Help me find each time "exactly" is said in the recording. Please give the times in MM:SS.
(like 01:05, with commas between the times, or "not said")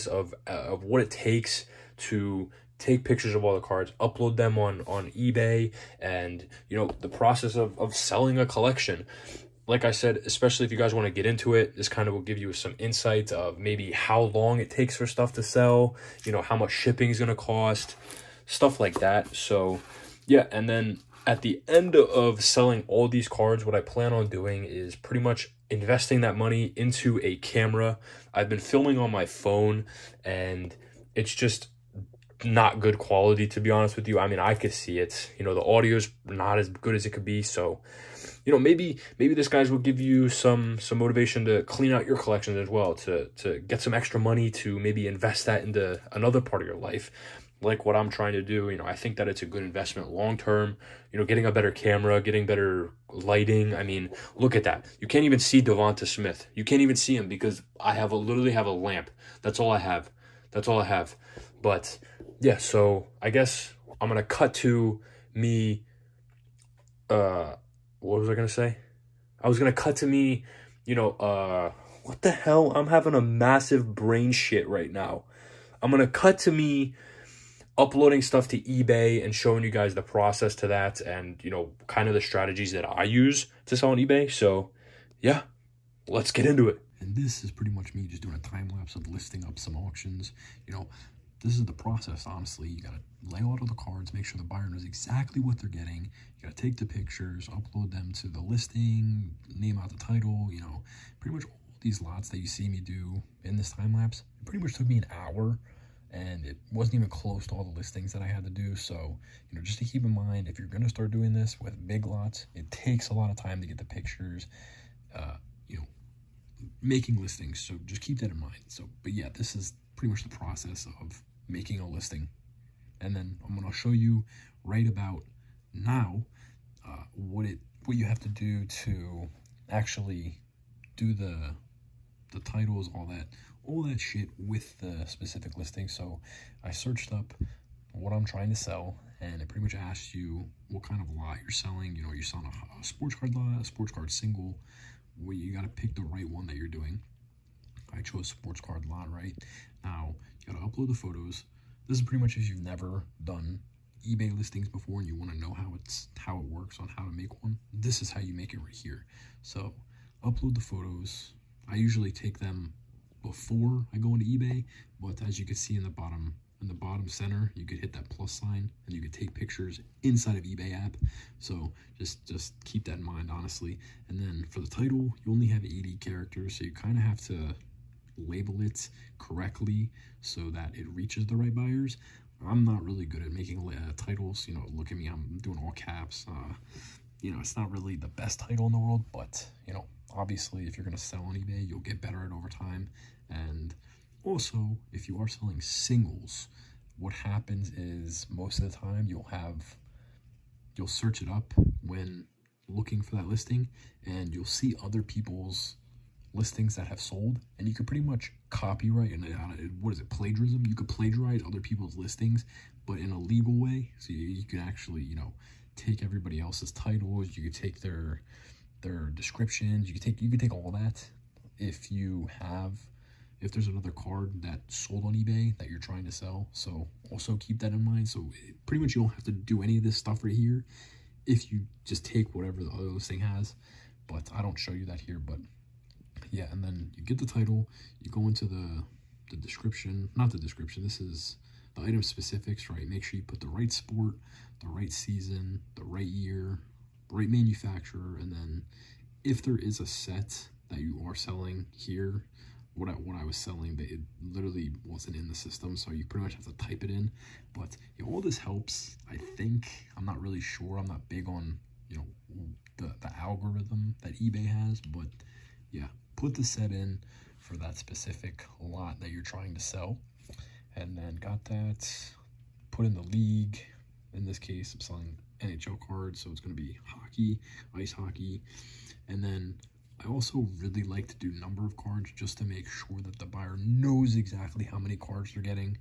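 01:34, 04:44.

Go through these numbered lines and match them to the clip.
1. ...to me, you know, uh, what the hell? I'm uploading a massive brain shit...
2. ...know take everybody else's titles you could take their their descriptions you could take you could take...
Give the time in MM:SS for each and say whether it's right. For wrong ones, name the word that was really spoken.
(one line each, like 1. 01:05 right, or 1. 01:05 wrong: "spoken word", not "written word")
1. 01:09 wrong: "having", not "uploading"
2. 03:35 right.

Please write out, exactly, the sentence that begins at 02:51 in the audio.
So just, just keep that in mind, honestly.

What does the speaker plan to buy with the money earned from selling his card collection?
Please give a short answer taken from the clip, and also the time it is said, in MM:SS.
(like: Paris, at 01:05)
A camera, at 00:27.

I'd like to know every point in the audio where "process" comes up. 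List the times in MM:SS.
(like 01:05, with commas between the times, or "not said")
00:07, 01:20, 01:31, 02:00.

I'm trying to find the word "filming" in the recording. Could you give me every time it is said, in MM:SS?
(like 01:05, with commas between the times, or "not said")
00:28.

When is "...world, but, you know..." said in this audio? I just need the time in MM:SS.
03:08.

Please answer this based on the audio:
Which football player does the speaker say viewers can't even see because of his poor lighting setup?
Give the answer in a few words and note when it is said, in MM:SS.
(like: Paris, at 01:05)
Devonta Smith, at 00:55.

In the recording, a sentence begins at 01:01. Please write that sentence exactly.
But yeah, so I guess I'm gonna cut to me.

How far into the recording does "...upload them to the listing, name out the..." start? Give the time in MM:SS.
01:37.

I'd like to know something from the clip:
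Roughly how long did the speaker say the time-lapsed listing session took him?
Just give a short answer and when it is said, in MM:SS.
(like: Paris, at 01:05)
An hour, at 01:44.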